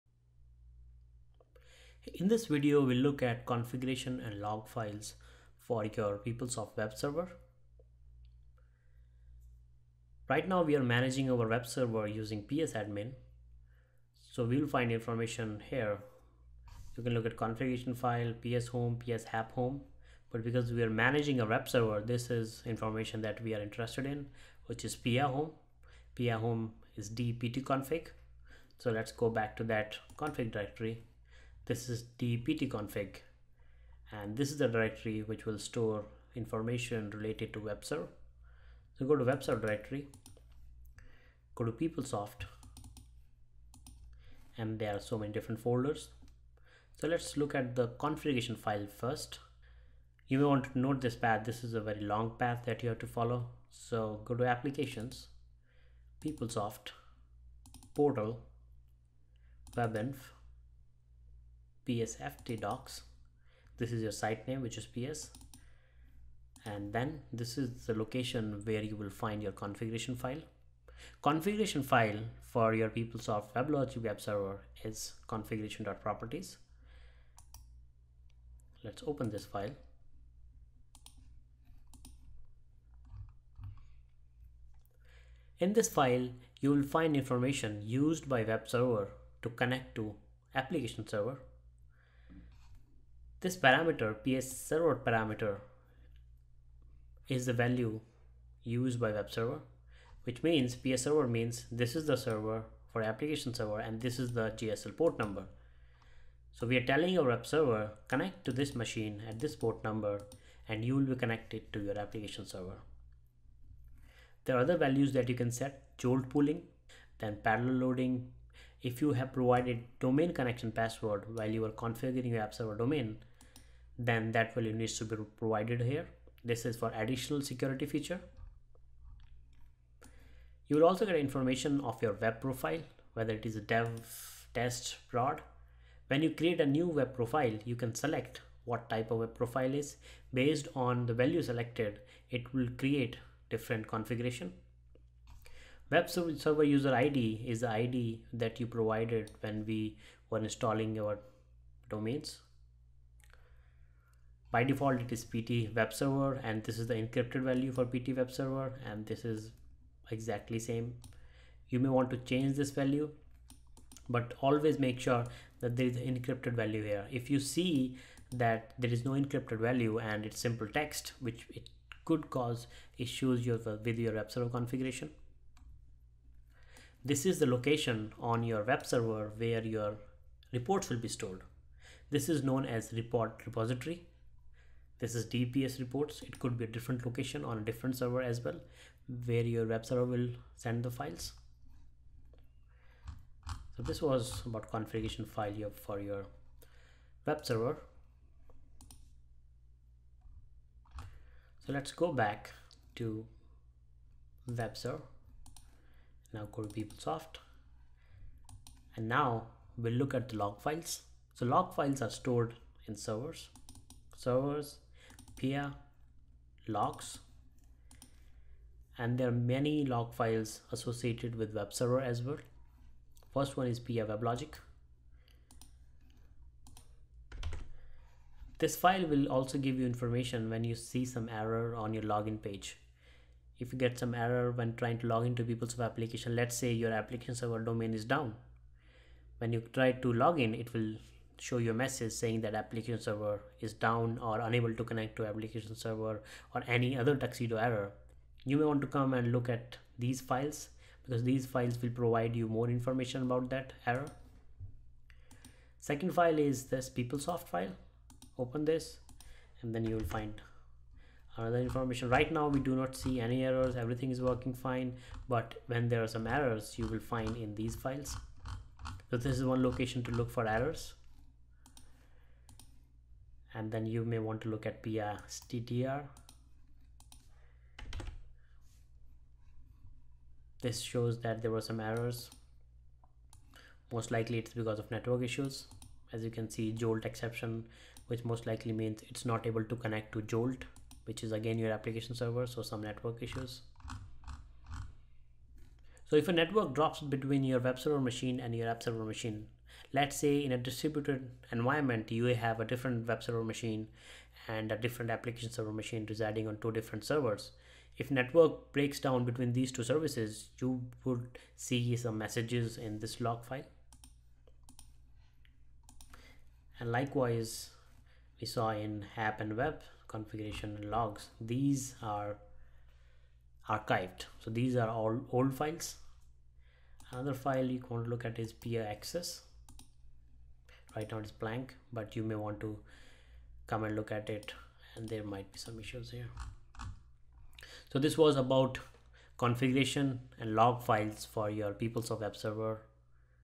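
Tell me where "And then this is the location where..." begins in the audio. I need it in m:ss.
1:06.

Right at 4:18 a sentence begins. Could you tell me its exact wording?
Open this and then you will find another information.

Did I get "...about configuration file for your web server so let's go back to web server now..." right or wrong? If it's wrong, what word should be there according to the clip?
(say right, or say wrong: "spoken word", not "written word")
right.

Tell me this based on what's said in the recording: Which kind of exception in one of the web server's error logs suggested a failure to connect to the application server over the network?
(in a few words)
Jolt exception.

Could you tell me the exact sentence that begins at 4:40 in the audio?
This shows that there were some errors.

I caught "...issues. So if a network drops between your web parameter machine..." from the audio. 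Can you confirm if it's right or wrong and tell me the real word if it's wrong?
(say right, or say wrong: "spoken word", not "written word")
wrong: "server", not "parameter".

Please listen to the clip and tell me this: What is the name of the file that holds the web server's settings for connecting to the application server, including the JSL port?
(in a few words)
configuration.properties.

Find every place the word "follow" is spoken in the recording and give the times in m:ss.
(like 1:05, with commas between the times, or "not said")
0:53.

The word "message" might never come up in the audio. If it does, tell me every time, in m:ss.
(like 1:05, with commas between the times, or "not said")
4:01, 5:12.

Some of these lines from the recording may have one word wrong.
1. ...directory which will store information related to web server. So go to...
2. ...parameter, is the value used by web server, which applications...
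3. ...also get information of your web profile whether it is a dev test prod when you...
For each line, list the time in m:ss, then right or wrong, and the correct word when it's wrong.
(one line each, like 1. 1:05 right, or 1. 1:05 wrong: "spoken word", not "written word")
1. 0:34 right
2. 1:34 wrong: "means", not "applications"
3. 2:10 right.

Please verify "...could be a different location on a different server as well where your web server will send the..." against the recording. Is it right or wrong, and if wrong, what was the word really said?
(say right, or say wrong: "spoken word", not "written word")
right.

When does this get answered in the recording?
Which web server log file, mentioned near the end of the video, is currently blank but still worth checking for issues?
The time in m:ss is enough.
5:28.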